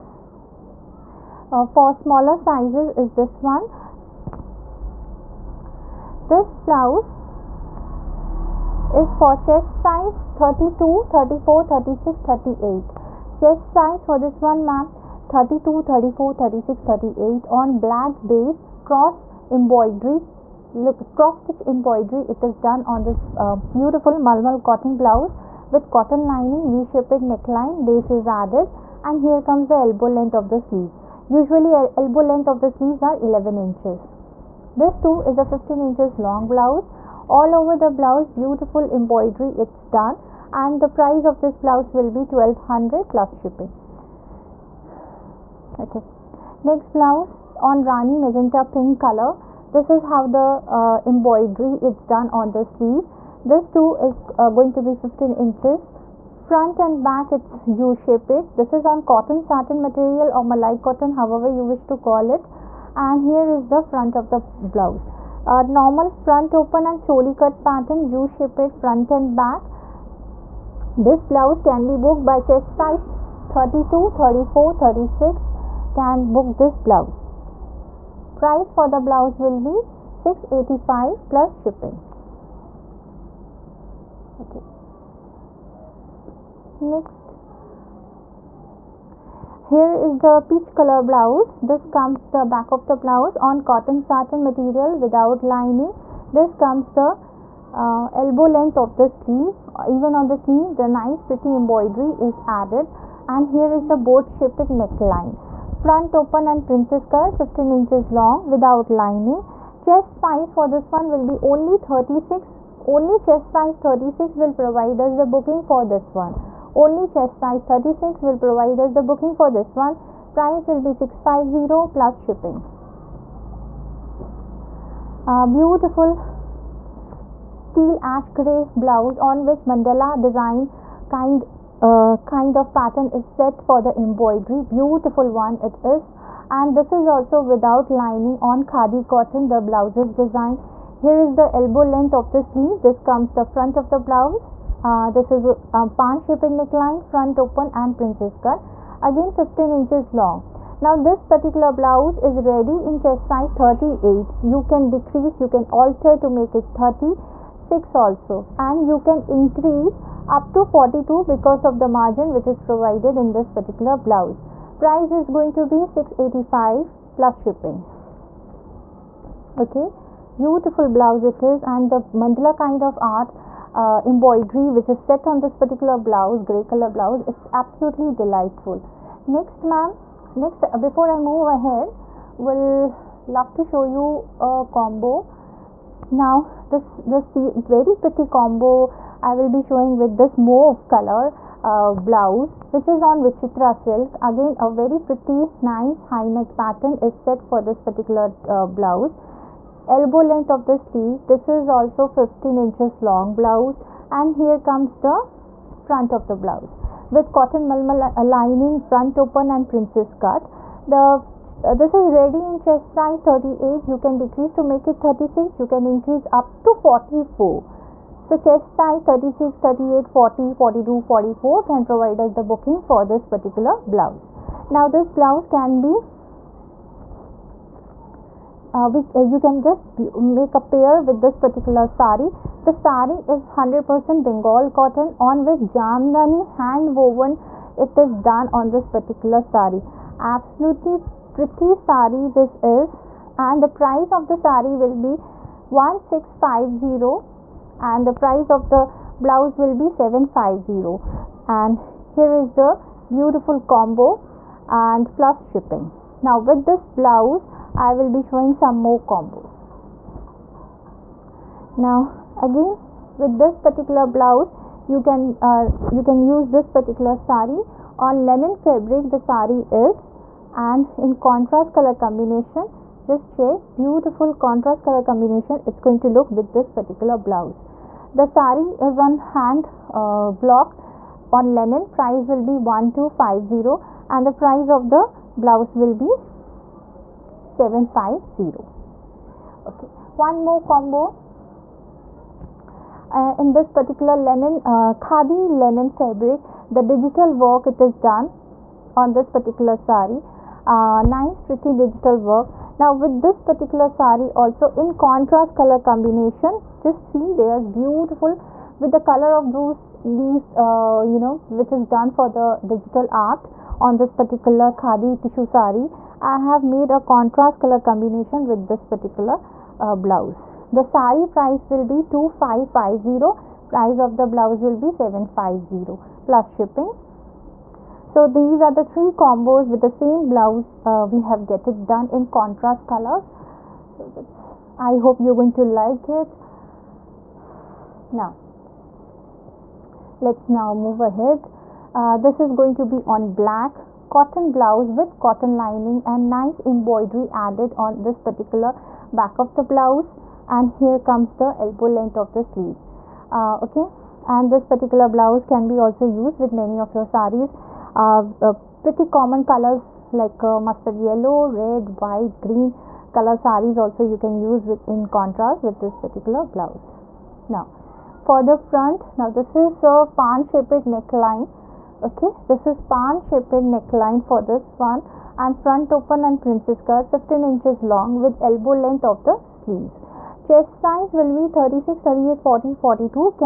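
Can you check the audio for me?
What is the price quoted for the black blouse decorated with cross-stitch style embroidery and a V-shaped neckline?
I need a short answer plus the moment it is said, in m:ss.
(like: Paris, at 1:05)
1200, at 0:42.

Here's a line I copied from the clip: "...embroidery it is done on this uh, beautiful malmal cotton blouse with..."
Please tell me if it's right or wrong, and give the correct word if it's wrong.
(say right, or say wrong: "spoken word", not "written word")
right.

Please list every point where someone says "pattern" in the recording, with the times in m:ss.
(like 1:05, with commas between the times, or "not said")
1:07, 2:12, 3:16.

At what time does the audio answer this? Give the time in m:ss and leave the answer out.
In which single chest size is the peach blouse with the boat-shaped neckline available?
1:51.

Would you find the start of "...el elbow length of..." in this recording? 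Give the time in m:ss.
0:31.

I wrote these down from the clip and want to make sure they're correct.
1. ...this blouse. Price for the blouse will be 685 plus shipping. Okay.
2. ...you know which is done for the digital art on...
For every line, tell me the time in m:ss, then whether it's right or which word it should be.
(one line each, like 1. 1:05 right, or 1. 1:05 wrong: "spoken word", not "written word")
1. 1:16 right
2. 5:11 right.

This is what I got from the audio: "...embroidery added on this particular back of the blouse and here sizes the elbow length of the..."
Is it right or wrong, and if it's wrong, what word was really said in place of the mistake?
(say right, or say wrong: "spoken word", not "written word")
wrong: "comes", not "sizes".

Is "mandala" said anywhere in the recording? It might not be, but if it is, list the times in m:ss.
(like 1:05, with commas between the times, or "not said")
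2:09, 2:52.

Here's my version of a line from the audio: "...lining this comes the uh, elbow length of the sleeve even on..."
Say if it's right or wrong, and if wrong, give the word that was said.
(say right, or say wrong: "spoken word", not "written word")
right.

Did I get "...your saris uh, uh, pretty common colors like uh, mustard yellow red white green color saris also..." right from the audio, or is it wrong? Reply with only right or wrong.
right.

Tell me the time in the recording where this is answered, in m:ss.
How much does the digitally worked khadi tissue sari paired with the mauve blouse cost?
5:22.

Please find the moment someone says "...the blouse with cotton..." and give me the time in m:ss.
3:26.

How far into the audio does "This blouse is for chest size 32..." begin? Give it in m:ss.
0:06.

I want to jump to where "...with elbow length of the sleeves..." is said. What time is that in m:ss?
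6:18.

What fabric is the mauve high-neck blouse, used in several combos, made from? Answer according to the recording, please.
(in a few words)
vichitra silk.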